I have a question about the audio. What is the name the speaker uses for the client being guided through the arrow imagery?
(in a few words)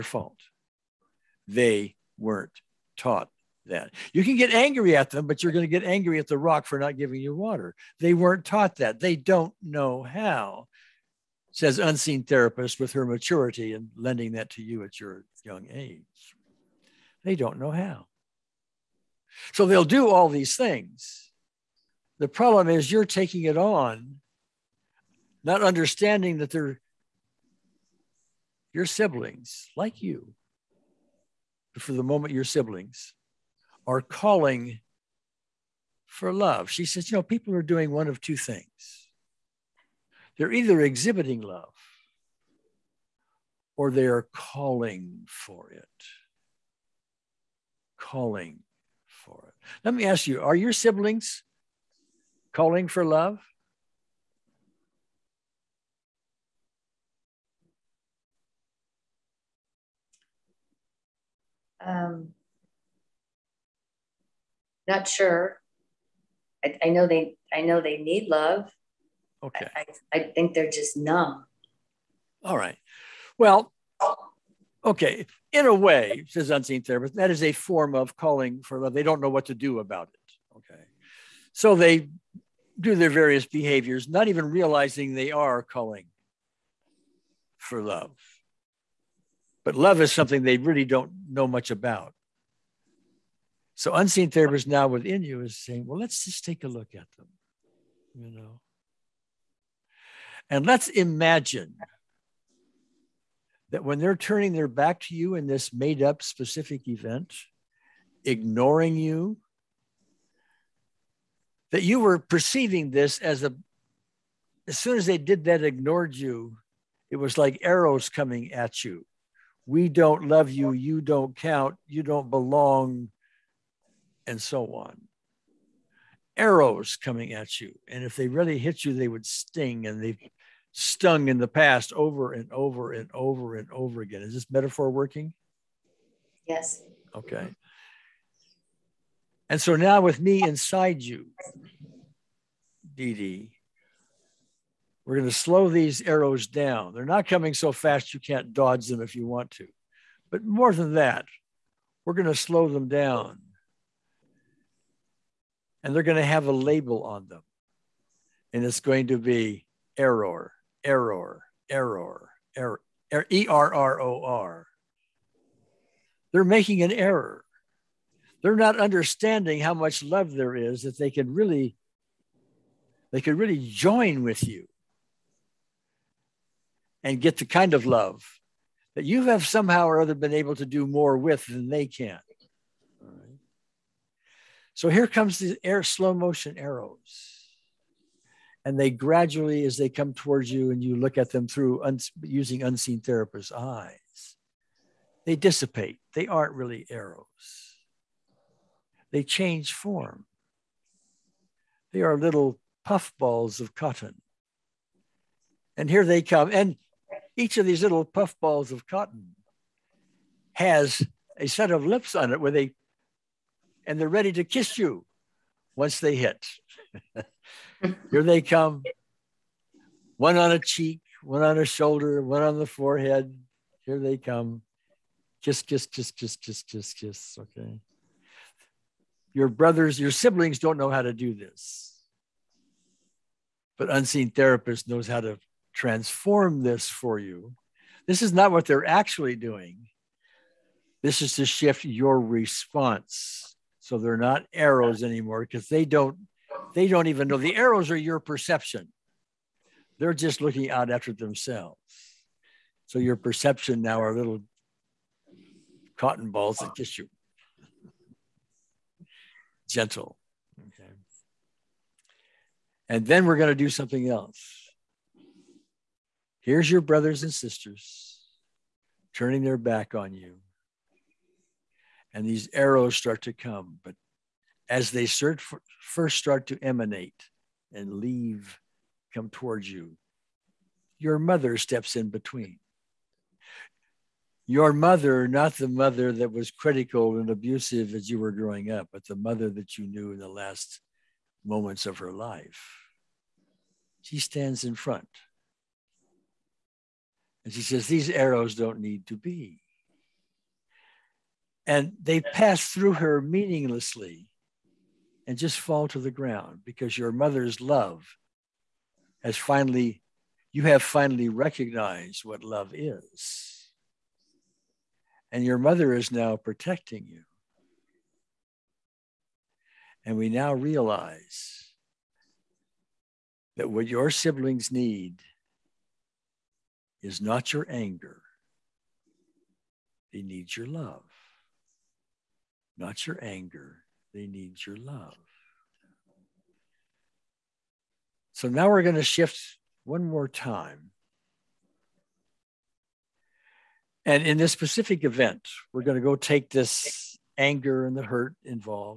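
Dee Dee.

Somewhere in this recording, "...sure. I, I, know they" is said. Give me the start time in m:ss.
1:05.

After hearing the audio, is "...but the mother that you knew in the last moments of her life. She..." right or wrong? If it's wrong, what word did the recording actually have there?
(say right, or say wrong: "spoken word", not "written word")
right.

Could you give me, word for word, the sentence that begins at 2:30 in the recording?
But more than that, we're going to slow them down.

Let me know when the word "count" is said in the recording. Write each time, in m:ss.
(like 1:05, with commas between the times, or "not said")
2:01.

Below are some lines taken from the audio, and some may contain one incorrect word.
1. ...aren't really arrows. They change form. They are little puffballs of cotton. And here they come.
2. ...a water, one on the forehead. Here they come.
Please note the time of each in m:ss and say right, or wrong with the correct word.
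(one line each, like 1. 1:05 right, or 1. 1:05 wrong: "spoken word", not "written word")
1. 3:16 right
2. 3:41 wrong: "shoulder", not "water".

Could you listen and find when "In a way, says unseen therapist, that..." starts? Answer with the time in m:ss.
1:15.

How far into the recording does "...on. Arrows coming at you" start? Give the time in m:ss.
2:04.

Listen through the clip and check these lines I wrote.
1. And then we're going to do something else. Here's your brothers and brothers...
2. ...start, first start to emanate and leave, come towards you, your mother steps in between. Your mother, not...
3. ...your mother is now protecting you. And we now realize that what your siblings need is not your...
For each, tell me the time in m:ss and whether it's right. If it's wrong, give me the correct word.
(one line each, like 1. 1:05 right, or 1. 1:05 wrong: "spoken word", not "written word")
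1. 4:22 wrong: "sisters", not "brothers"
2. 4:35 right
3. 5:15 right.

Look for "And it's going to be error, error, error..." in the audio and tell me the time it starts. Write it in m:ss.
2:38.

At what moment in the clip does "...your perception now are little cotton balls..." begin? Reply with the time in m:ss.
4:12.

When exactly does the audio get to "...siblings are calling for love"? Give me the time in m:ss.
0:32.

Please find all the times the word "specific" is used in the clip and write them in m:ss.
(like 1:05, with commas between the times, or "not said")
1:46, 5:44.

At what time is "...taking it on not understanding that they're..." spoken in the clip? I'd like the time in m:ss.
0:23.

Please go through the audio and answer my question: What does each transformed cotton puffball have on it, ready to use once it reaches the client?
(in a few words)
A set of lips.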